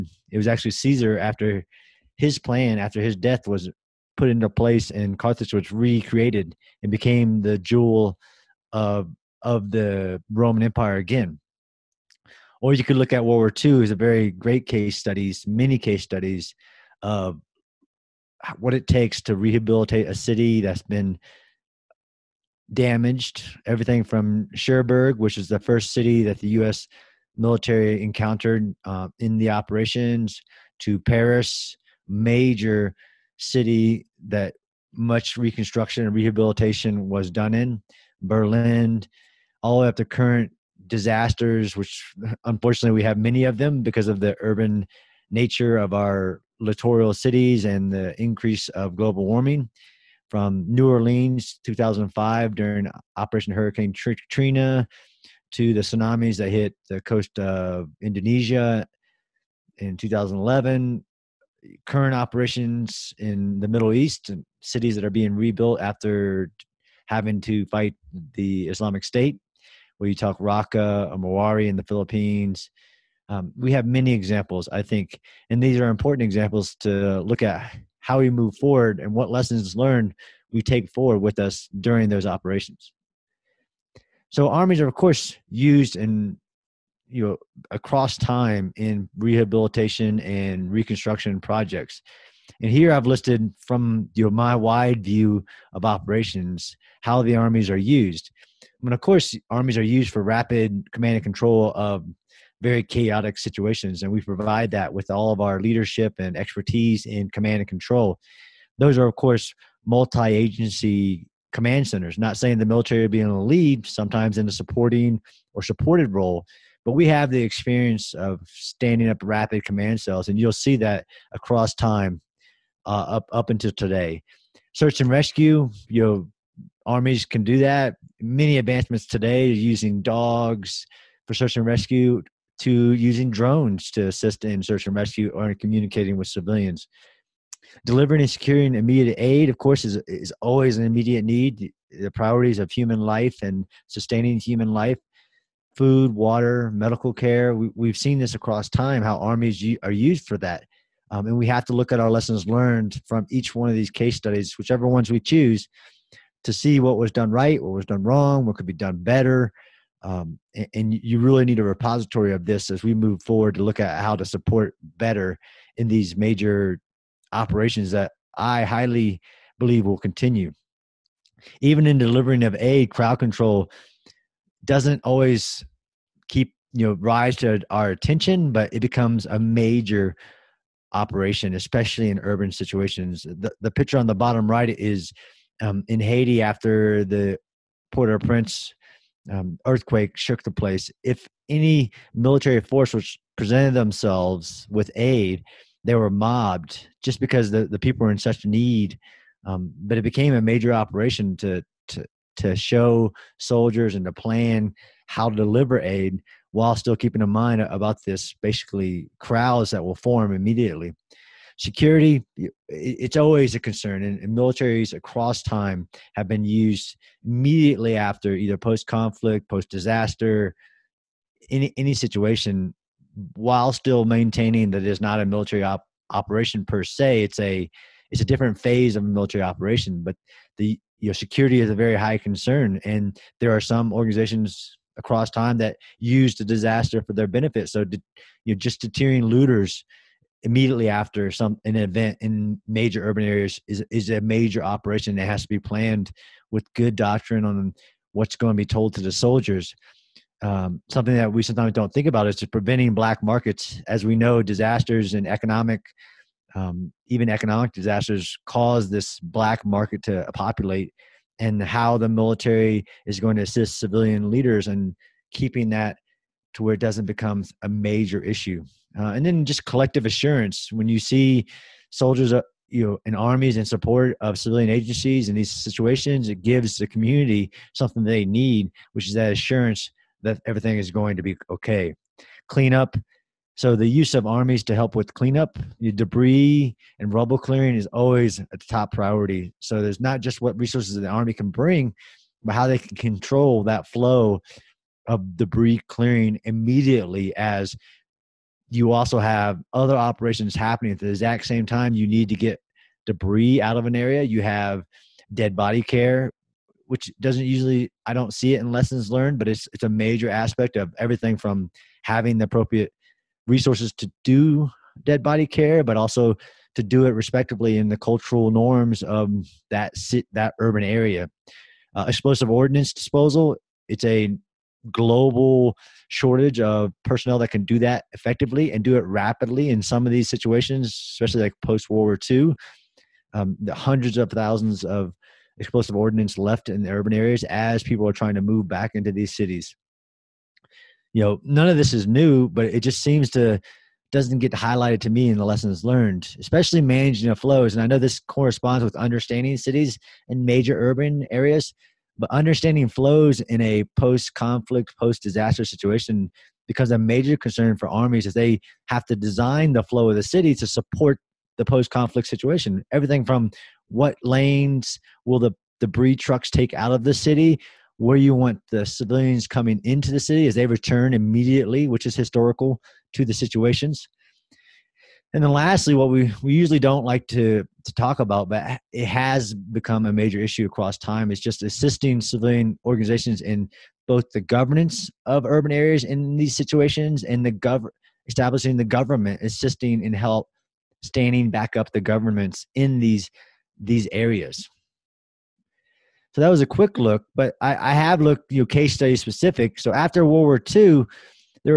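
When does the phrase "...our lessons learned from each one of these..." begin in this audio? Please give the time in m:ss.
2:31.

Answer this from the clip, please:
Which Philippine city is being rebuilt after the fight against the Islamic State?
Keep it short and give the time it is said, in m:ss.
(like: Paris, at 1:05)
Mawari, at 1:11.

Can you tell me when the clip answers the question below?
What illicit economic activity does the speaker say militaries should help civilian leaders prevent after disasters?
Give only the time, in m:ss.
4:12.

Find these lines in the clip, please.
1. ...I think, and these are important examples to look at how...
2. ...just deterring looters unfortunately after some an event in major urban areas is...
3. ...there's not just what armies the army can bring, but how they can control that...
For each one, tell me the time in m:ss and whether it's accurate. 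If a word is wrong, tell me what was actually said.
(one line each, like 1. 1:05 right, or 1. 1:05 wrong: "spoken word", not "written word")
1. 1:14 right
2. 3:58 wrong: "immediately", not "unfortunately"
3. 4:49 wrong: "resources", not "armies".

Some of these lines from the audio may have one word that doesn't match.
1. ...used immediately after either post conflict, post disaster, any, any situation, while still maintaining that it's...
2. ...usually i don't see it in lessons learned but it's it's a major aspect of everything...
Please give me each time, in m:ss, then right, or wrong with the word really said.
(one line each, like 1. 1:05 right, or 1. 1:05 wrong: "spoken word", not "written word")
1. 3:36 right
2. 5:07 right.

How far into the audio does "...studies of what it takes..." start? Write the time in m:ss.
0:16.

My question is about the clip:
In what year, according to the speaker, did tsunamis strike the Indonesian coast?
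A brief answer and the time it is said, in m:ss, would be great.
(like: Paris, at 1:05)
2011, at 0:59.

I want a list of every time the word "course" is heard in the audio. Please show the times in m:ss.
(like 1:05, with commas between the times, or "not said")
1:24, 1:39, 1:49, 2:19.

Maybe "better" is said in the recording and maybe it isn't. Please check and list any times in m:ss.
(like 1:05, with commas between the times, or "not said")
2:38, 2:44.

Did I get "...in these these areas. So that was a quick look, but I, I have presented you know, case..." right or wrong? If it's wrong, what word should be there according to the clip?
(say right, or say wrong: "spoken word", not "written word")
wrong: "looked", not "presented".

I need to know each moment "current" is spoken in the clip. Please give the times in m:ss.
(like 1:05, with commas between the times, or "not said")
0:40, 1:01.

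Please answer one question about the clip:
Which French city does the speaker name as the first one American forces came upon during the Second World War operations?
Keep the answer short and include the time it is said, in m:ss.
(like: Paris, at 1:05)
Cherbourg, at 0:24.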